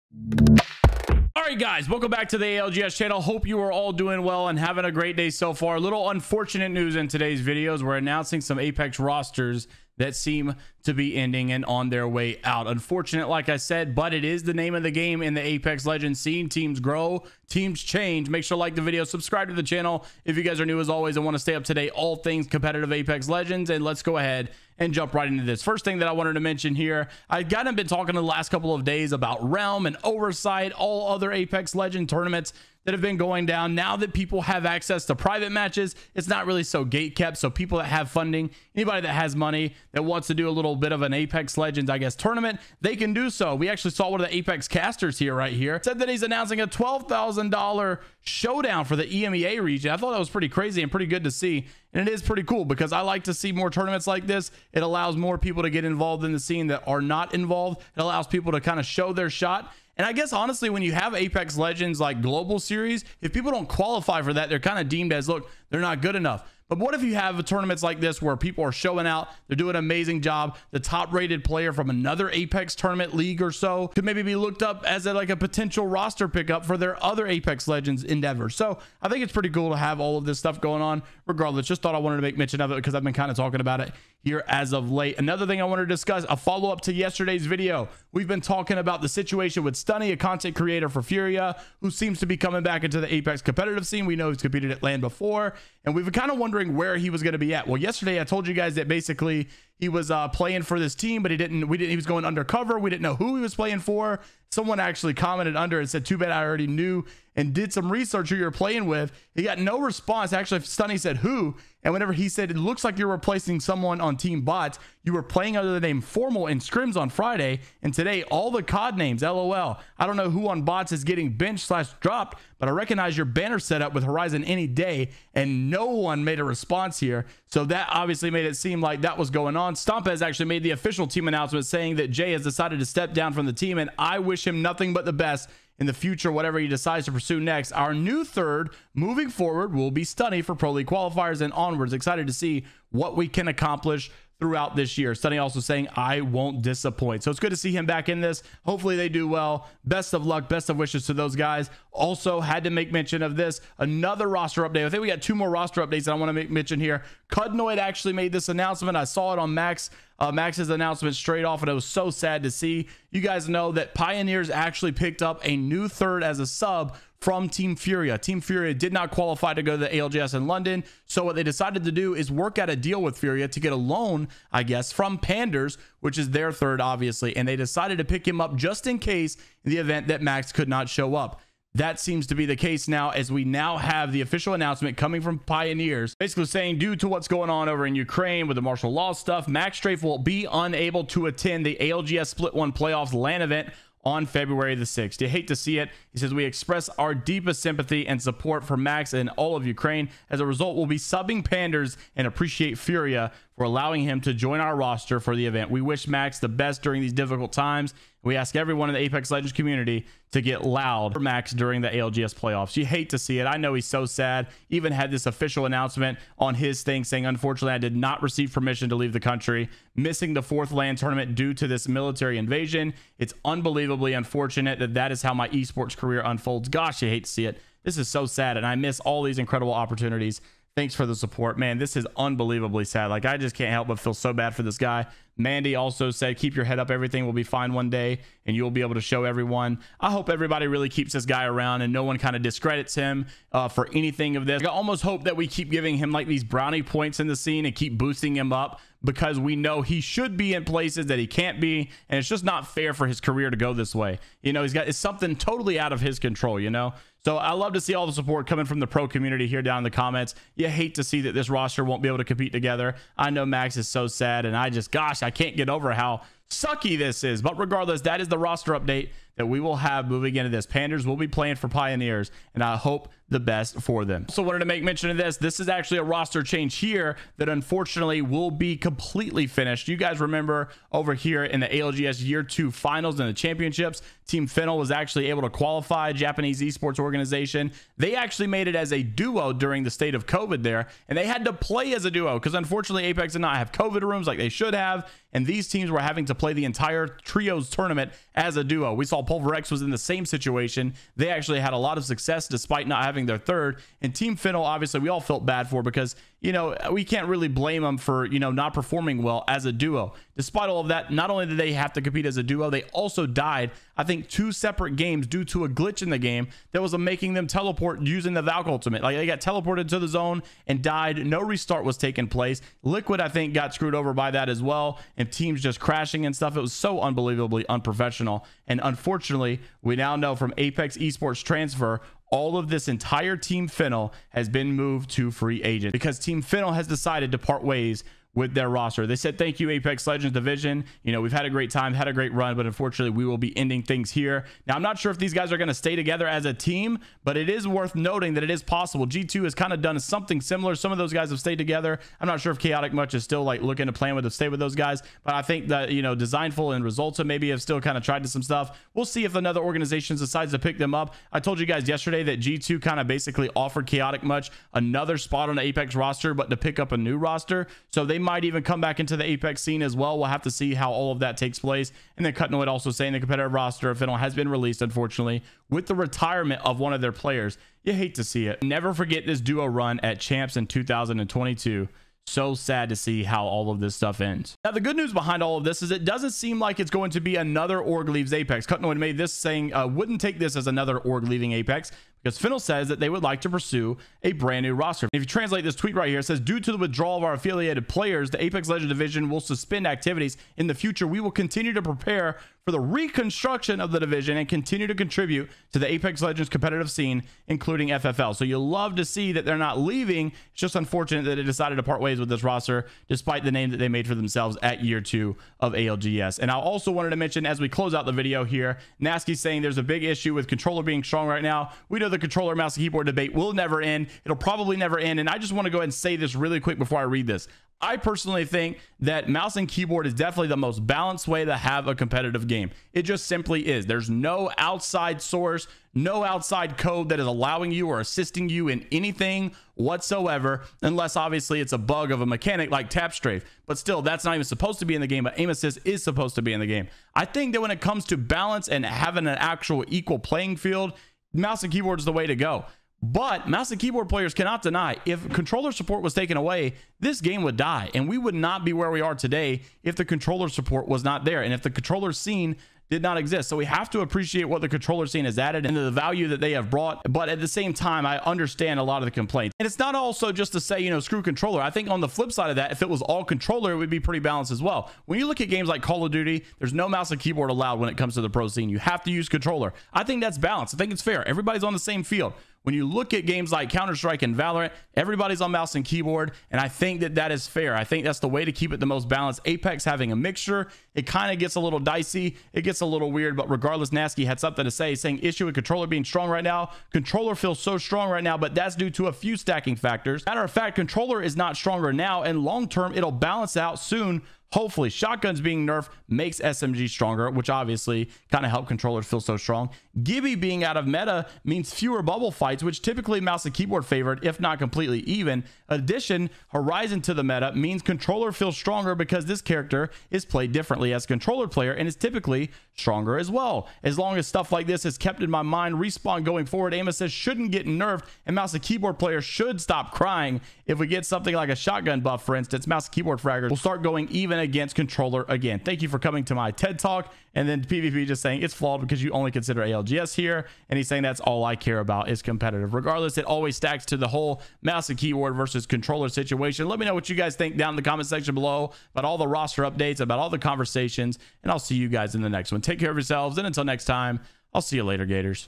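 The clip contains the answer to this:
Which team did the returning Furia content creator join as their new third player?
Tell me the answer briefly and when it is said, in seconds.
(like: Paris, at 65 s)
Team Bots, at 114 s.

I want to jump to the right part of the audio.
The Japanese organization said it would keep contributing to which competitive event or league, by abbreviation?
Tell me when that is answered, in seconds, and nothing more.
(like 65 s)
407 s.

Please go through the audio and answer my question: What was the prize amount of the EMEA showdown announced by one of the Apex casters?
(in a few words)
$12,000.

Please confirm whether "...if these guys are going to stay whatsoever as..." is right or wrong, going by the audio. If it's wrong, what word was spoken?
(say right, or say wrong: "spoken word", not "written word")
wrong: "together", not "whatsoever".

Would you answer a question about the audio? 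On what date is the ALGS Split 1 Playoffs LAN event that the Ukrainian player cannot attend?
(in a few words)
February 6.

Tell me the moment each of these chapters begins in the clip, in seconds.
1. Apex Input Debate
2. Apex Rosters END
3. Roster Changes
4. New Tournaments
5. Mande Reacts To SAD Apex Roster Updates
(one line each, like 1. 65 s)
1. 419 s
2. 277 s
3. 85 s
4. 25 s
5. 156 s.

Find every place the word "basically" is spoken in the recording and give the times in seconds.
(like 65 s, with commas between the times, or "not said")
98 s, 186 s, 363 s.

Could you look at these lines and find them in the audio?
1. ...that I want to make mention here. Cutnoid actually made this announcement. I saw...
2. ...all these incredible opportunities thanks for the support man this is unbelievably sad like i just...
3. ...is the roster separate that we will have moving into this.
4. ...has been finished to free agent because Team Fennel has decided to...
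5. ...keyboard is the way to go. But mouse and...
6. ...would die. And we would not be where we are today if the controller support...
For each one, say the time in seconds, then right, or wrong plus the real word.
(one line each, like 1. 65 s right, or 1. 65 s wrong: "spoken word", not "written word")
1. 156 s right
2. 229 s right
3. 268 s wrong: "update", not "separate"
4. 334 s wrong: "moved", not "finished"
5. 451 s right
6. 457 s right.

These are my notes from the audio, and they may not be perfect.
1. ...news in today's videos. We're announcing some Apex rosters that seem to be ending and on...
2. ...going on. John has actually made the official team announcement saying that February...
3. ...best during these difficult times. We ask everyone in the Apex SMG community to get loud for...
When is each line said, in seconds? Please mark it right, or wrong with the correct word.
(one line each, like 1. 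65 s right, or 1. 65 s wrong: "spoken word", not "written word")
1. 6 s right
2. 129 s wrong: "Jay", not "February"
3. 206 s wrong: "Legends", not "SMG".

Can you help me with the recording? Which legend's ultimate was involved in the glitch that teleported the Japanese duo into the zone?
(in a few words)
Valk.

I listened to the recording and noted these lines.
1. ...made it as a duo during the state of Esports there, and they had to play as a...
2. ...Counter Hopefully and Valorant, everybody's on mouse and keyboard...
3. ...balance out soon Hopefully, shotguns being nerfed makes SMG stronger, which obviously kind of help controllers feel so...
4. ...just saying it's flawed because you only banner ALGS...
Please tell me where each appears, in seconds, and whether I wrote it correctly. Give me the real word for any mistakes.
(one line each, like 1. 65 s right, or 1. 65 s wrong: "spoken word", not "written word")
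1. 288 s wrong: "COVID", not "Esports"
2. 483 s wrong: "Strike", not "Hopefully"
3. 503 s right
4. 538 s wrong: "consider", not "banner".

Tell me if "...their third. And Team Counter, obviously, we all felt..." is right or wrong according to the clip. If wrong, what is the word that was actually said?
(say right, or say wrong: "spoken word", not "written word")
wrong: "Fennel", not "Counter".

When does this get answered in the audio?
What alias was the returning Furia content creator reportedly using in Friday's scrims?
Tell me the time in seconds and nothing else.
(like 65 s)
115 s.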